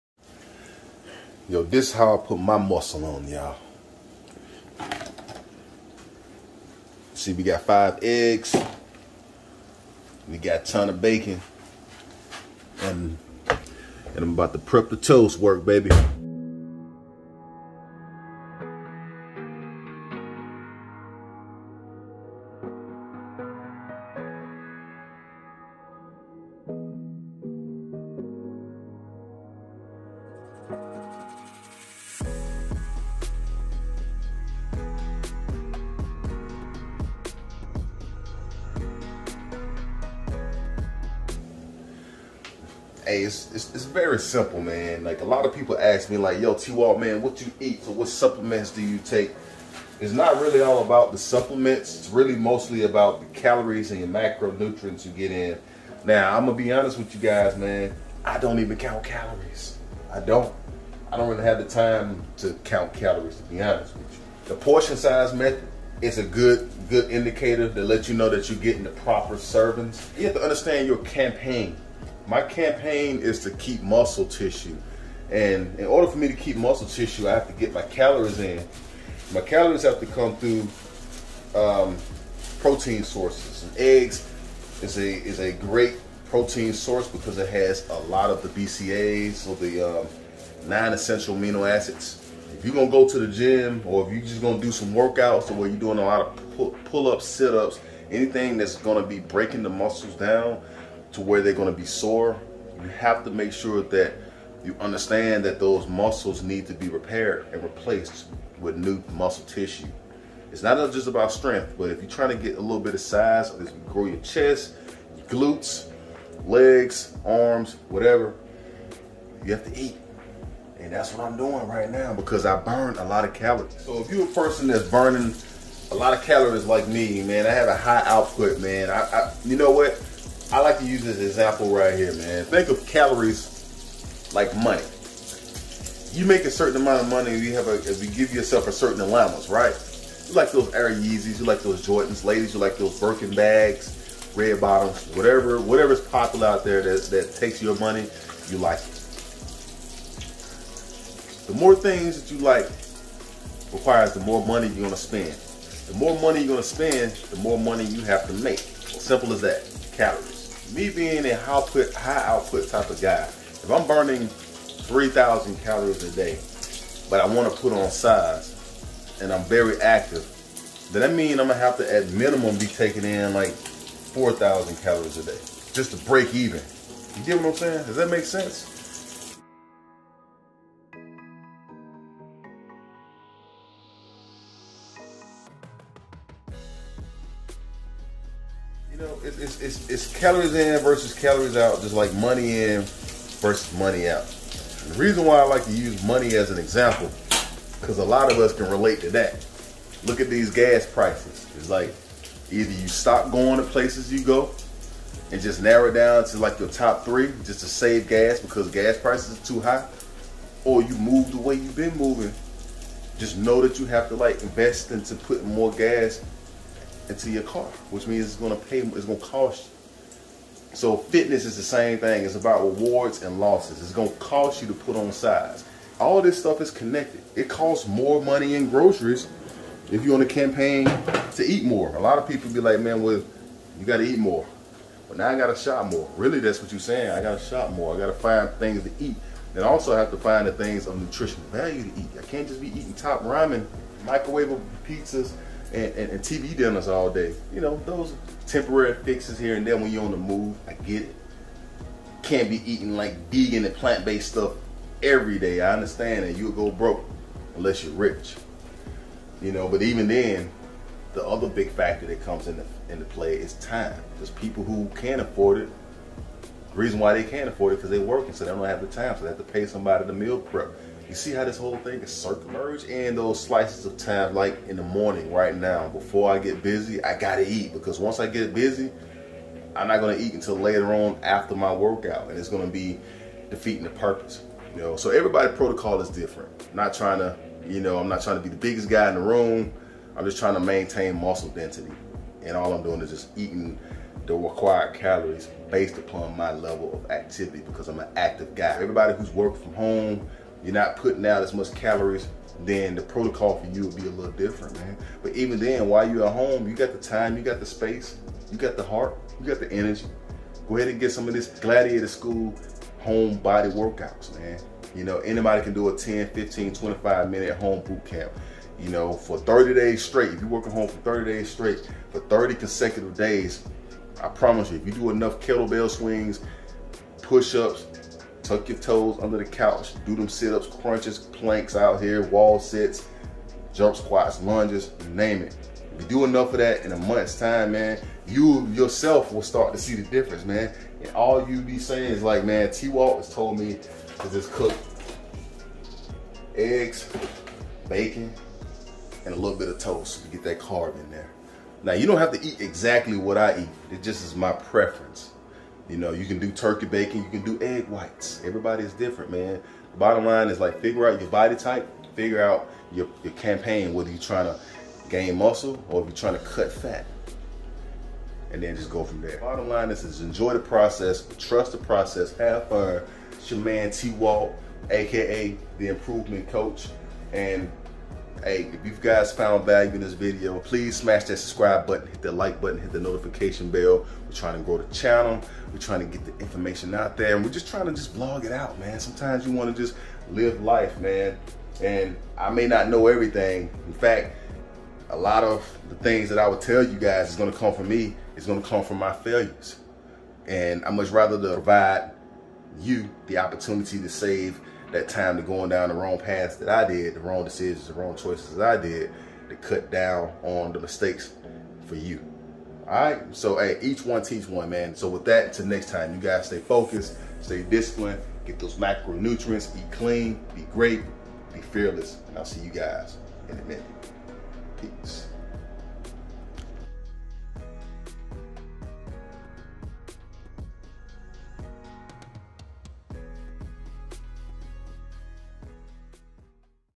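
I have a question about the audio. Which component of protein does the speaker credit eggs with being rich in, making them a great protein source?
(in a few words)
BCAAs.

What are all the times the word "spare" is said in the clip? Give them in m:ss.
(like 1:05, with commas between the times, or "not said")
not said.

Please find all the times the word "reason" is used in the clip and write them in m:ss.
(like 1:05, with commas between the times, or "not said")
3:15, 4:26.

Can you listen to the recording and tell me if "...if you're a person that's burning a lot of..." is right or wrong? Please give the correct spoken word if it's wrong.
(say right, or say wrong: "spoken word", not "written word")
right.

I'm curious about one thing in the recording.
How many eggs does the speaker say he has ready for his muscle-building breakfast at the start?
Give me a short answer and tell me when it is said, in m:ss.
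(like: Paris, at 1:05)
5, at 0:07.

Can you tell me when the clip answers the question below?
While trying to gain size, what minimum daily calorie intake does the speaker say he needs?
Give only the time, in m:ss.
2:53.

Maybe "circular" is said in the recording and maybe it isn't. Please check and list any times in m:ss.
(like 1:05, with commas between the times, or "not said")
4:32.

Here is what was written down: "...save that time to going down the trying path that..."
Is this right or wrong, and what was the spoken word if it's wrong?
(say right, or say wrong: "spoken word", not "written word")
wrong: "wrong", not "trying".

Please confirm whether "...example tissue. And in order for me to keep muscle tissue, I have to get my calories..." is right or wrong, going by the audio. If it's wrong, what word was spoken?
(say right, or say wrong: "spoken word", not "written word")
wrong: "muscle", not "example".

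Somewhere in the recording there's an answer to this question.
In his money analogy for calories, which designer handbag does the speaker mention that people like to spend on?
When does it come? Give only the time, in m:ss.
2:22.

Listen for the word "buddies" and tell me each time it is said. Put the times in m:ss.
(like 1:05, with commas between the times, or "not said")
not said.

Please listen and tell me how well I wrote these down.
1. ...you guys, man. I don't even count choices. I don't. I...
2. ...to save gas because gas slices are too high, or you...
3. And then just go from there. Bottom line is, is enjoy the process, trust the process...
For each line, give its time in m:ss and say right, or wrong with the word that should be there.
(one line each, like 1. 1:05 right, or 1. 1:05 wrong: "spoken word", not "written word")
1. 0:57 wrong: "calories", not "choices"
2. 3:27 wrong: "prices", not "slices"
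3. 6:08 right.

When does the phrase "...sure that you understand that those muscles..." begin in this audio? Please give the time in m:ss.
1:43.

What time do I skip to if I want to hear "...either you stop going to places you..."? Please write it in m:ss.
3:22.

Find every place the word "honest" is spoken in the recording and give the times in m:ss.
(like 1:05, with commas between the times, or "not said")
0:56, 1:03.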